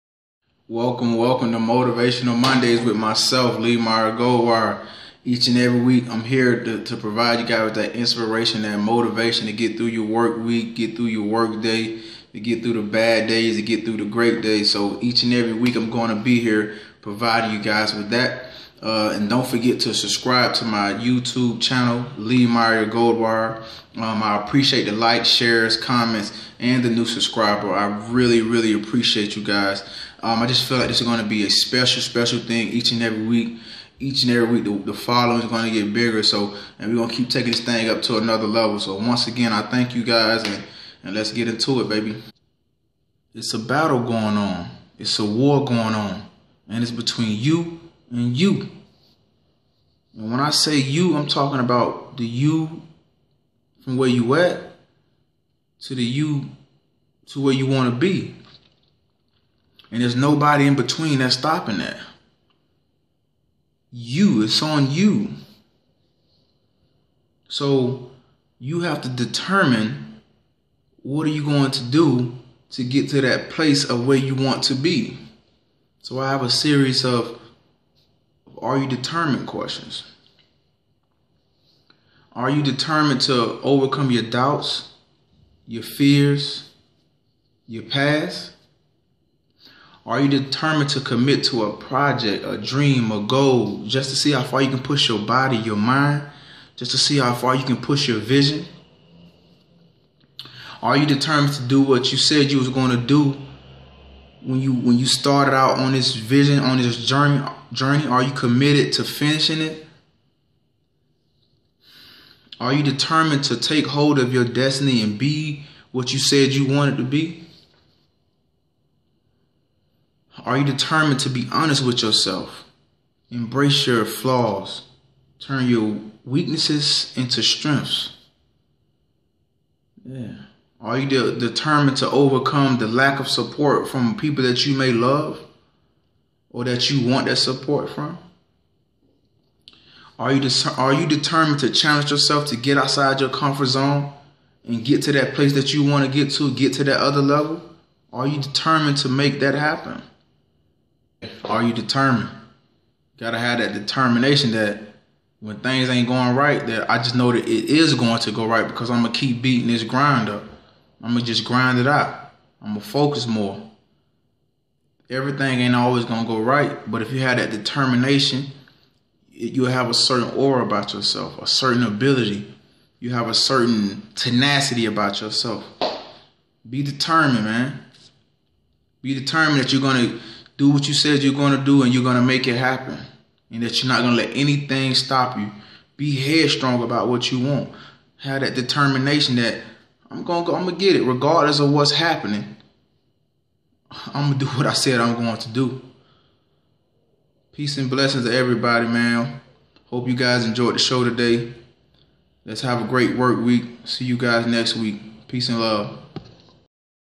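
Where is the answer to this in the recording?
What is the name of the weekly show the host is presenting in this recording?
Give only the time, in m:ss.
0:01.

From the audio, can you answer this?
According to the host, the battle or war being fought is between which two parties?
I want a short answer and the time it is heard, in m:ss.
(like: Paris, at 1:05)
you and you, at 0:47.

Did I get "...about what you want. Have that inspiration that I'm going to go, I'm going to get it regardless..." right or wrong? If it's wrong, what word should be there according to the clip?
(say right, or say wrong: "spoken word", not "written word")
wrong: "determination", not "inspiration".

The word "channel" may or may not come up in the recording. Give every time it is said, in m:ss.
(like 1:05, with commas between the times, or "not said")
0:21.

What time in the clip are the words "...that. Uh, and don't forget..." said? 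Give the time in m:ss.
0:18.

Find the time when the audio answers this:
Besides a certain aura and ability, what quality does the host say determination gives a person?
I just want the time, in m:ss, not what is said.
2:54.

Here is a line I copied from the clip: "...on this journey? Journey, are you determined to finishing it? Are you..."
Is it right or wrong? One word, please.
wrong.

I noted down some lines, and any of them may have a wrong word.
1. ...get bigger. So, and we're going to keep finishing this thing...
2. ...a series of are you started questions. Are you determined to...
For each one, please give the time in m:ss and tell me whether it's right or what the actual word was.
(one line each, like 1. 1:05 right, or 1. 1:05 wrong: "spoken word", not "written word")
1. 0:35 wrong: "taking", not "finishing"
2. 1:16 wrong: "determined", not "started".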